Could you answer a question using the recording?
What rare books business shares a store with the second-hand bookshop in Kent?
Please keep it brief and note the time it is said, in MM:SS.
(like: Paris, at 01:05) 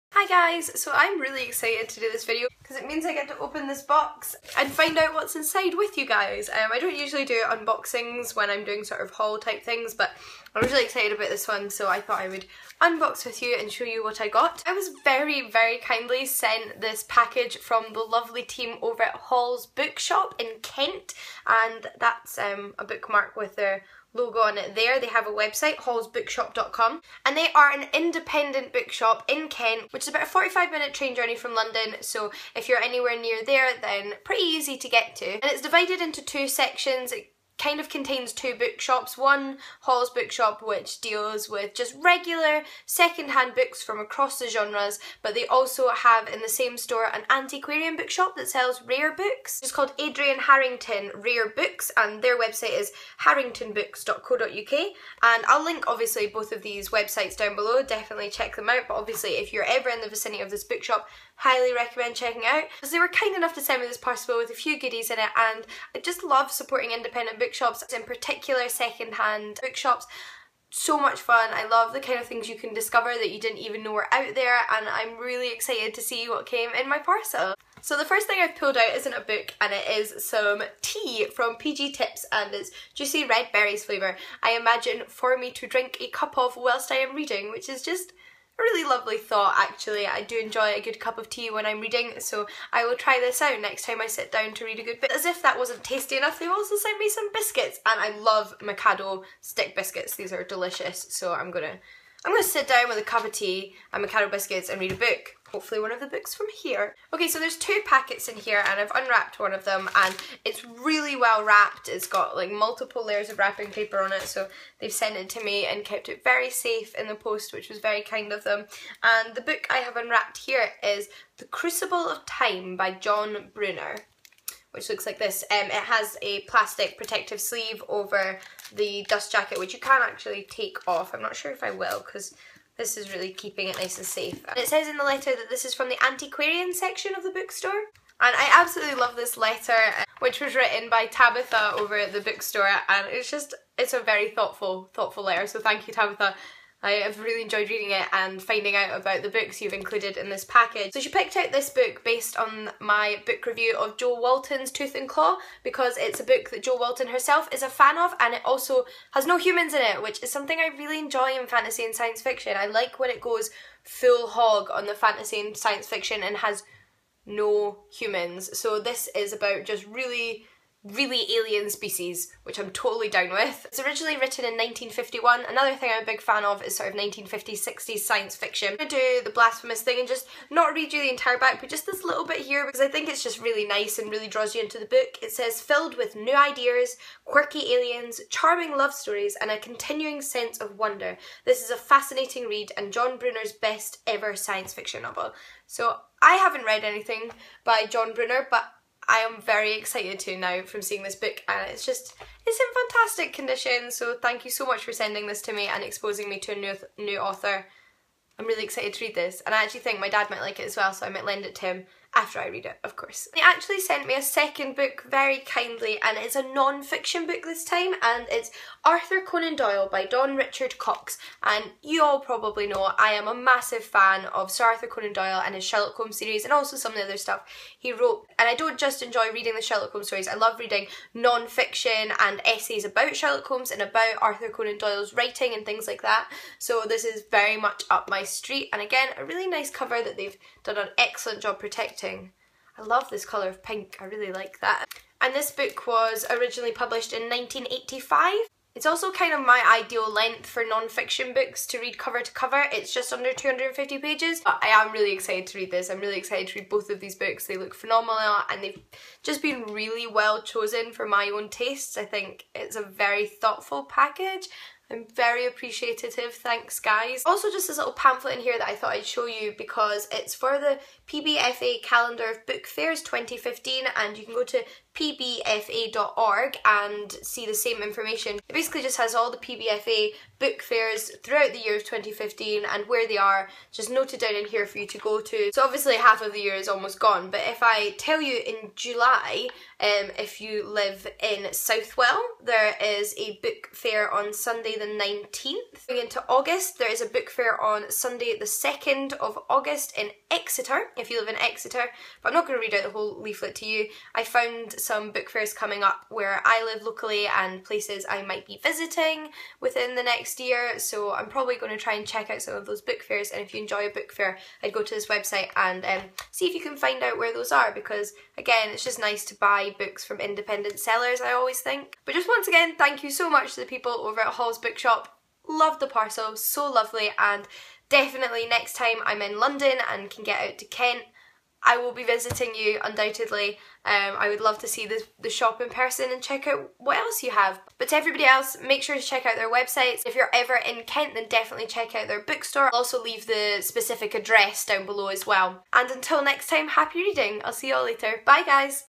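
Adrian Harrington Rare Books, at 00:49.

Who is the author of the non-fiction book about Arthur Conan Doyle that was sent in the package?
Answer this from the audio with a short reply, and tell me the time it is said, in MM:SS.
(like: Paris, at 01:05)
Don Richard Cox, at 03:40.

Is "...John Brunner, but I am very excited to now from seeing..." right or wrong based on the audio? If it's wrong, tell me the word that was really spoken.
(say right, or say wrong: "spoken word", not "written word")
right.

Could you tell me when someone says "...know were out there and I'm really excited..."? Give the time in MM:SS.
01:13.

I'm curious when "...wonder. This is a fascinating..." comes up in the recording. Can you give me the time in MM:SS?
03:10.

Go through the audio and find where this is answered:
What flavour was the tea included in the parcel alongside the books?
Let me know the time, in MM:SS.
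01:22.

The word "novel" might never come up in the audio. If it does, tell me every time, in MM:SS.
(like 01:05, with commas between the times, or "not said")
03:15.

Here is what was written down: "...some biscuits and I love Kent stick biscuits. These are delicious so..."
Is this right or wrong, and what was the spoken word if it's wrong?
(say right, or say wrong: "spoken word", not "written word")
wrong: "Mikado", not "Kent".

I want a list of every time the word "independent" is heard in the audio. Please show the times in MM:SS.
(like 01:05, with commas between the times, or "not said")
00:27, 01:06, 05:20.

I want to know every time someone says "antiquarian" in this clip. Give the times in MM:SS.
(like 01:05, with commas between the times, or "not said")
00:47, 02:16.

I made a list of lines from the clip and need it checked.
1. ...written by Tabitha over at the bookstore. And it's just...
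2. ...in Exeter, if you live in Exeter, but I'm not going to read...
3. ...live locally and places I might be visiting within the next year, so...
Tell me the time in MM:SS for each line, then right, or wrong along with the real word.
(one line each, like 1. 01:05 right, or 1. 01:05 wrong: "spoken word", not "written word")
1. 02:20 right
2. 04:59 right
3. 05:06 right.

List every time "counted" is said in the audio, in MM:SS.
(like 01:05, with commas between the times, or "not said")
not said.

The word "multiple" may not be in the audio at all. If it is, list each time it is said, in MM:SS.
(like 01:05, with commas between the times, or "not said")
01:52.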